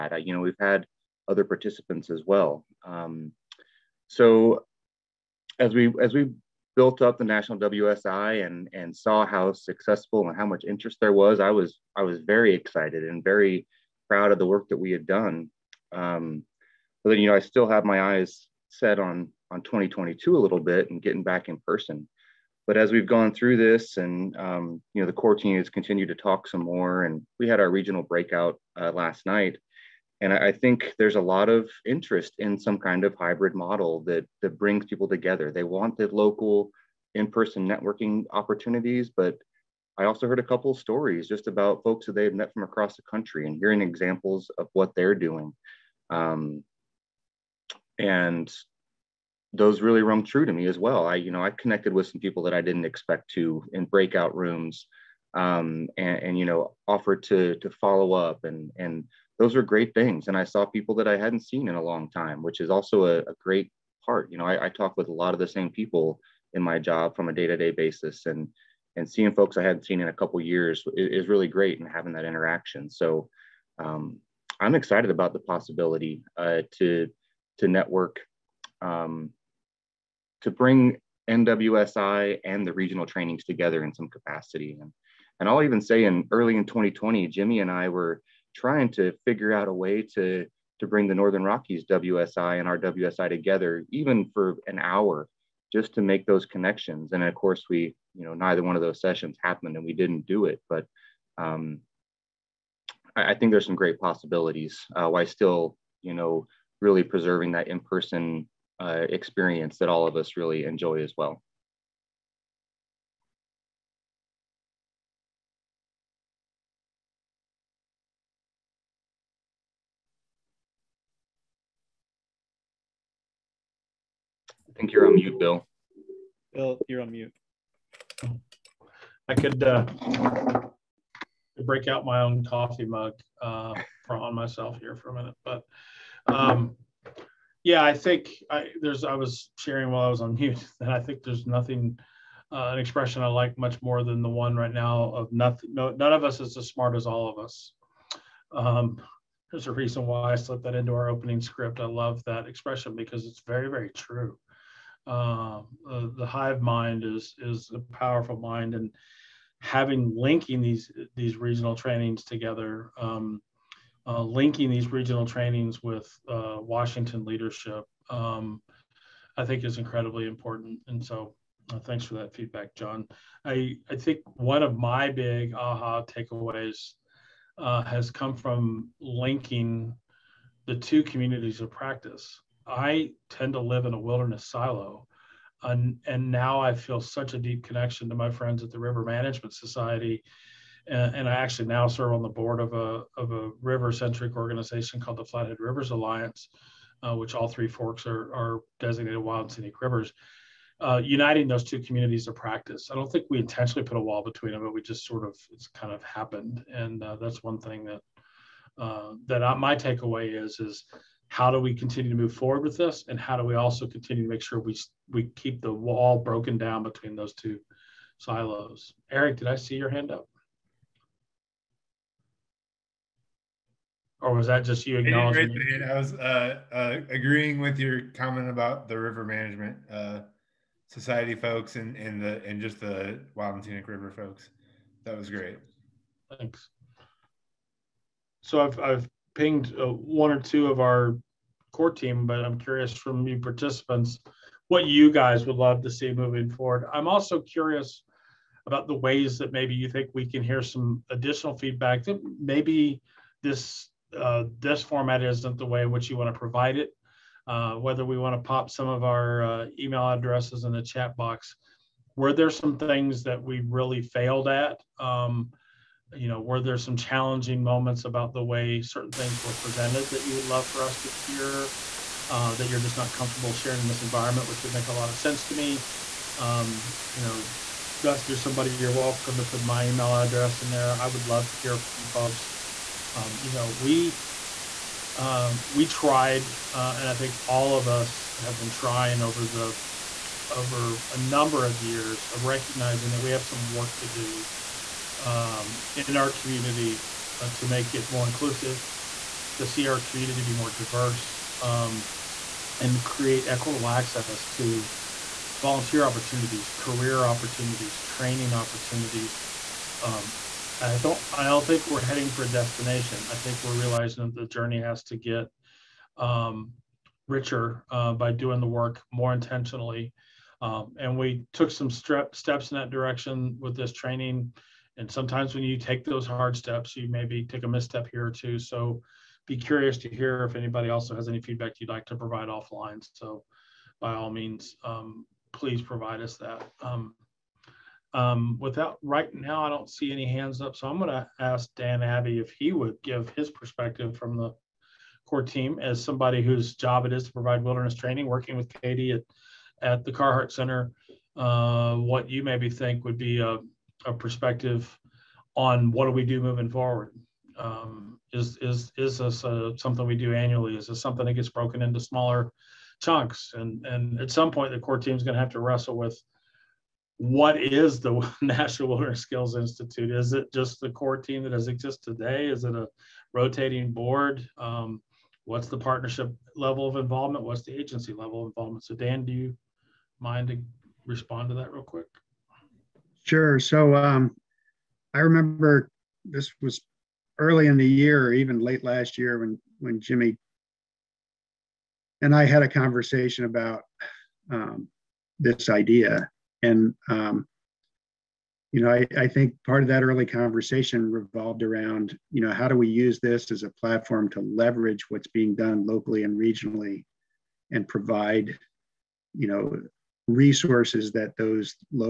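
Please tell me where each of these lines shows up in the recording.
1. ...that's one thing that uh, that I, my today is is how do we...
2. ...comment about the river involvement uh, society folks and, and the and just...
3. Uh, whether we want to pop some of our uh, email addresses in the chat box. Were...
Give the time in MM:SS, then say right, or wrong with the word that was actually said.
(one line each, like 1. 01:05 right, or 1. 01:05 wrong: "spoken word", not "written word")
1. 03:27 wrong: "takeaway", not "today"
2. 03:48 wrong: "management", not "involvement"
3. 04:17 right.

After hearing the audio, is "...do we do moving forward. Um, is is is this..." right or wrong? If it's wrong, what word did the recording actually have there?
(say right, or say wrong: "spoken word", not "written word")
right.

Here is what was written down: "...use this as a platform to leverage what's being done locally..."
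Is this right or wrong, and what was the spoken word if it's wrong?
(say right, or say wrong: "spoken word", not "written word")
right.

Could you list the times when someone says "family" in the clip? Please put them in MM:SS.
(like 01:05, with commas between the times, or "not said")
not said.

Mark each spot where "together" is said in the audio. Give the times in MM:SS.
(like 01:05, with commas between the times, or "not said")
00:35, 01:23, 01:33, 02:42.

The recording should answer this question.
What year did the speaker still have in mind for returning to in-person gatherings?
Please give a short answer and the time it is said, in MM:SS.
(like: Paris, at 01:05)
2022, at 00:19.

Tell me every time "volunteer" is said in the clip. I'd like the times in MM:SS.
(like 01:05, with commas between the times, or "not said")
05:05.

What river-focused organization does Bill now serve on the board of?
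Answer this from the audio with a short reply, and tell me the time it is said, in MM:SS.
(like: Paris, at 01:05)
Flathead Rivers Alliance, at 03:15.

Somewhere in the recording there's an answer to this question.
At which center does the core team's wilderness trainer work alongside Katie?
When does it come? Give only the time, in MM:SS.
05:50.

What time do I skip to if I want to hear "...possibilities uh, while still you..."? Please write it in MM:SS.
01:44.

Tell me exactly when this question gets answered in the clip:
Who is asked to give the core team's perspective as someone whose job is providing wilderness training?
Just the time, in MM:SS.
05:41.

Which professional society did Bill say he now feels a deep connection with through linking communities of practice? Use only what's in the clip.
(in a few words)
River Management Society.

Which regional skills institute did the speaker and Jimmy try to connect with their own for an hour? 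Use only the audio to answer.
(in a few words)
Northern Rockies WSI.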